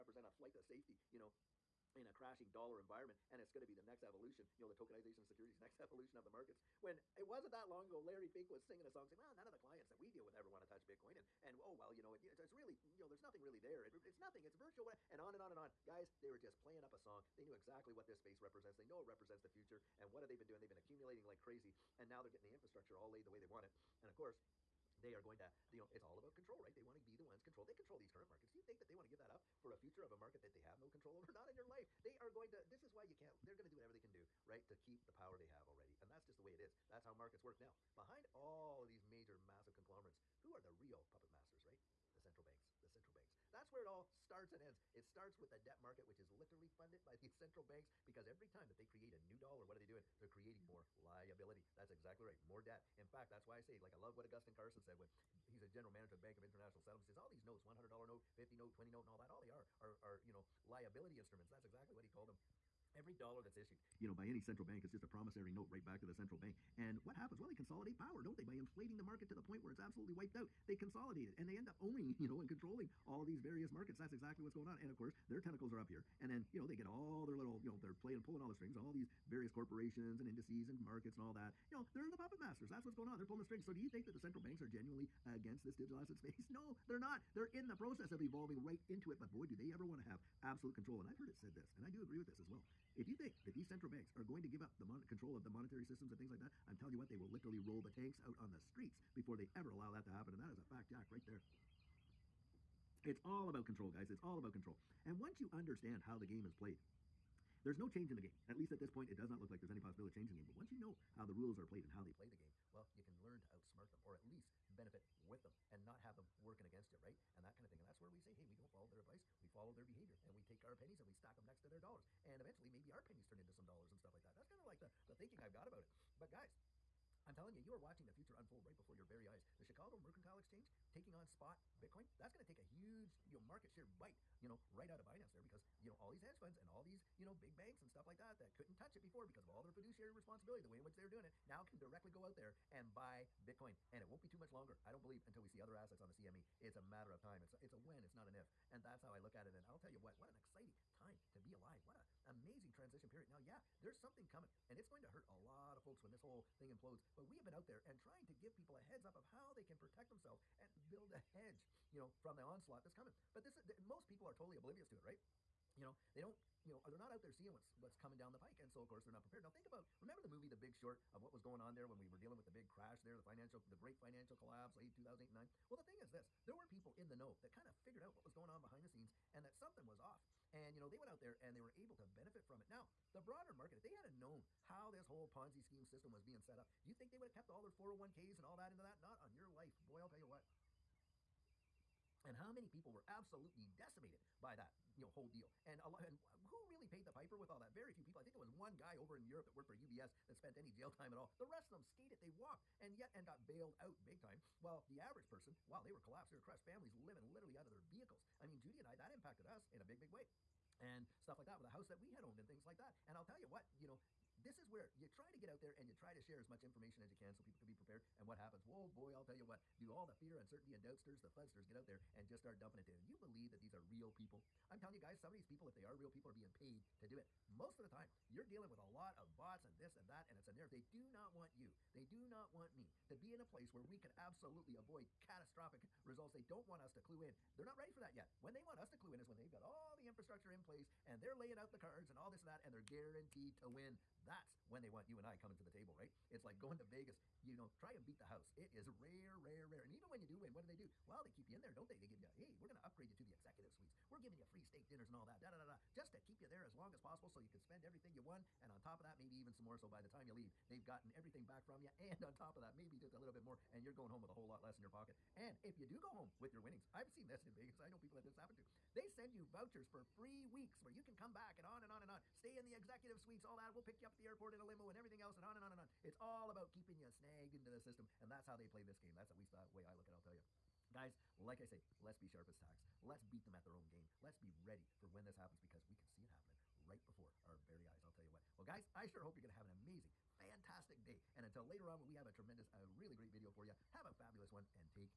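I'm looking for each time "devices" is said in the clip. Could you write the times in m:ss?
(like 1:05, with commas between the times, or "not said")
not said.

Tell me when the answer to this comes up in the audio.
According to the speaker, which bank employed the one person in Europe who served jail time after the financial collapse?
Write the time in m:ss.
3:19.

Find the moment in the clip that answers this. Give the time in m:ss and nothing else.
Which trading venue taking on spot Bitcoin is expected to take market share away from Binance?
2:09.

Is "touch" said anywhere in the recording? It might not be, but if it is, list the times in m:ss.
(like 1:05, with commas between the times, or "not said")
0:10, 2:18.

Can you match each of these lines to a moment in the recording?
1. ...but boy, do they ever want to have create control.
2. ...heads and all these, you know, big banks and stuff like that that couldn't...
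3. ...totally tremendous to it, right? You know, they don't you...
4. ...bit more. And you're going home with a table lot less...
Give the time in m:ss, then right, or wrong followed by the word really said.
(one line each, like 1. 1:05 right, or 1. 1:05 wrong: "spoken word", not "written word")
1. 1:29 wrong: "absolute", not "create"
2. 2:16 wrong: "funds", not "heads"
3. 2:44 wrong: "oblivious", not "tremendous"
4. 4:23 wrong: "whole", not "table".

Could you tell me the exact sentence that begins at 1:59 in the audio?
We follow their behavior and we take our pennies and we stack them next to their dollars.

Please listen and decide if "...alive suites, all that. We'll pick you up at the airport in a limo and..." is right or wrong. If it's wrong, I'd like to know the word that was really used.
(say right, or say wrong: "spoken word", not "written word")
wrong: "executive", not "alive".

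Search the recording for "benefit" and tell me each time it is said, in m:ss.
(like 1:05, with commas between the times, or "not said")
1:54, 3:02.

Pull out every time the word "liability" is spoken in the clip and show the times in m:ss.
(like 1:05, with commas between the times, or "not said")
0:51, 1:00.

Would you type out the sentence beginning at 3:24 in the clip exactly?
While the average person, wow, they were collapsed, they were crushed.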